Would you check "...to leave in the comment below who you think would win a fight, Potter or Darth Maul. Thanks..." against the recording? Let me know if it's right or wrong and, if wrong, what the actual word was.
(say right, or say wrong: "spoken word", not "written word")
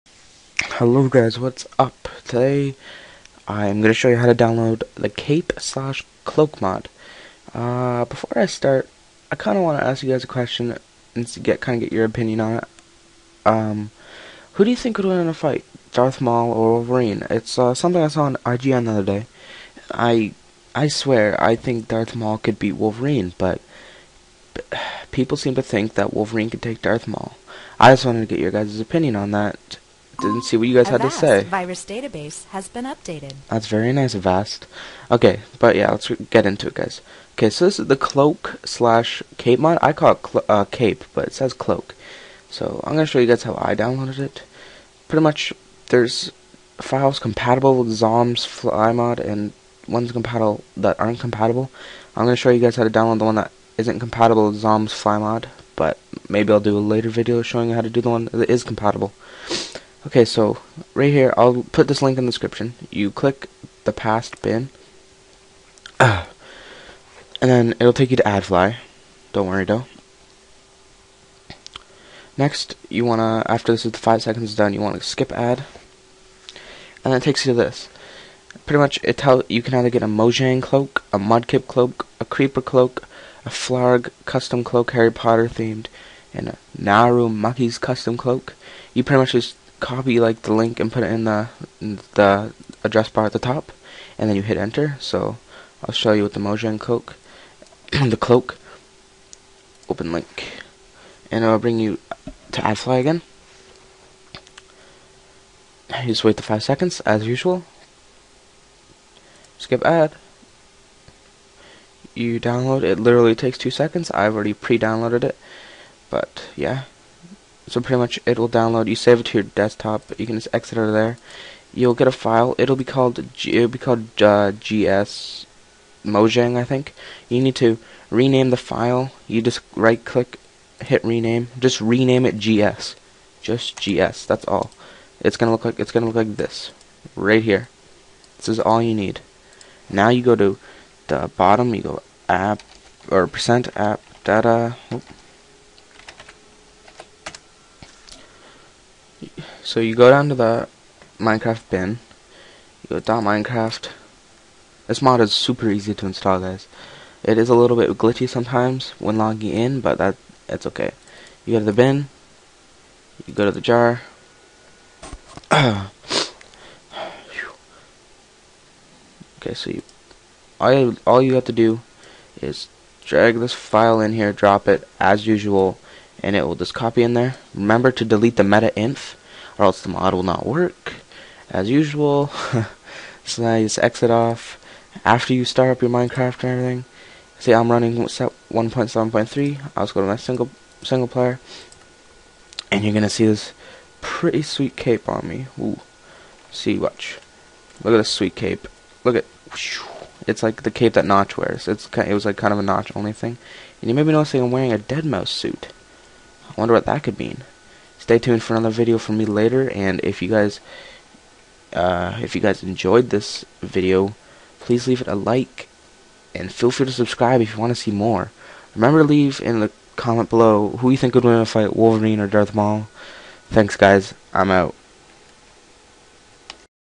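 wrong: "Wolverine", not "Potter".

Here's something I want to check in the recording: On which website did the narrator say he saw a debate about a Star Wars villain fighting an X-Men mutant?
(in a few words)
IGN.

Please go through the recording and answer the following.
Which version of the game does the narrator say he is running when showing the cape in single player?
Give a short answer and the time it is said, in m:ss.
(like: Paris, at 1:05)
1.7.3, at 3:07.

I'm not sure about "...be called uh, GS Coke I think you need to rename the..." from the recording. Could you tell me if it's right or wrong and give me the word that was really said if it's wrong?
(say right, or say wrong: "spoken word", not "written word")
wrong: "Mojang", not "Coke".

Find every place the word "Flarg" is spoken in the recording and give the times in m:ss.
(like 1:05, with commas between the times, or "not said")
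1:23.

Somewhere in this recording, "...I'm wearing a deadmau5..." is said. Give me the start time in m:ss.
3:24.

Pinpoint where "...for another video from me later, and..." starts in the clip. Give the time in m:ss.
3:28.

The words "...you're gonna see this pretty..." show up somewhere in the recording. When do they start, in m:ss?
3:12.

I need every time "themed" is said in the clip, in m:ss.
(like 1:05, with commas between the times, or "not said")
1:25.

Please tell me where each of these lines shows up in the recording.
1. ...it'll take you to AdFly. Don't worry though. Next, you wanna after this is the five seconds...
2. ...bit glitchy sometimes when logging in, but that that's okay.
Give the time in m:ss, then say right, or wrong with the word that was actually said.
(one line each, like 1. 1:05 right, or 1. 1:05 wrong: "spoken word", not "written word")
1. 1:07 right
2. 2:37 right.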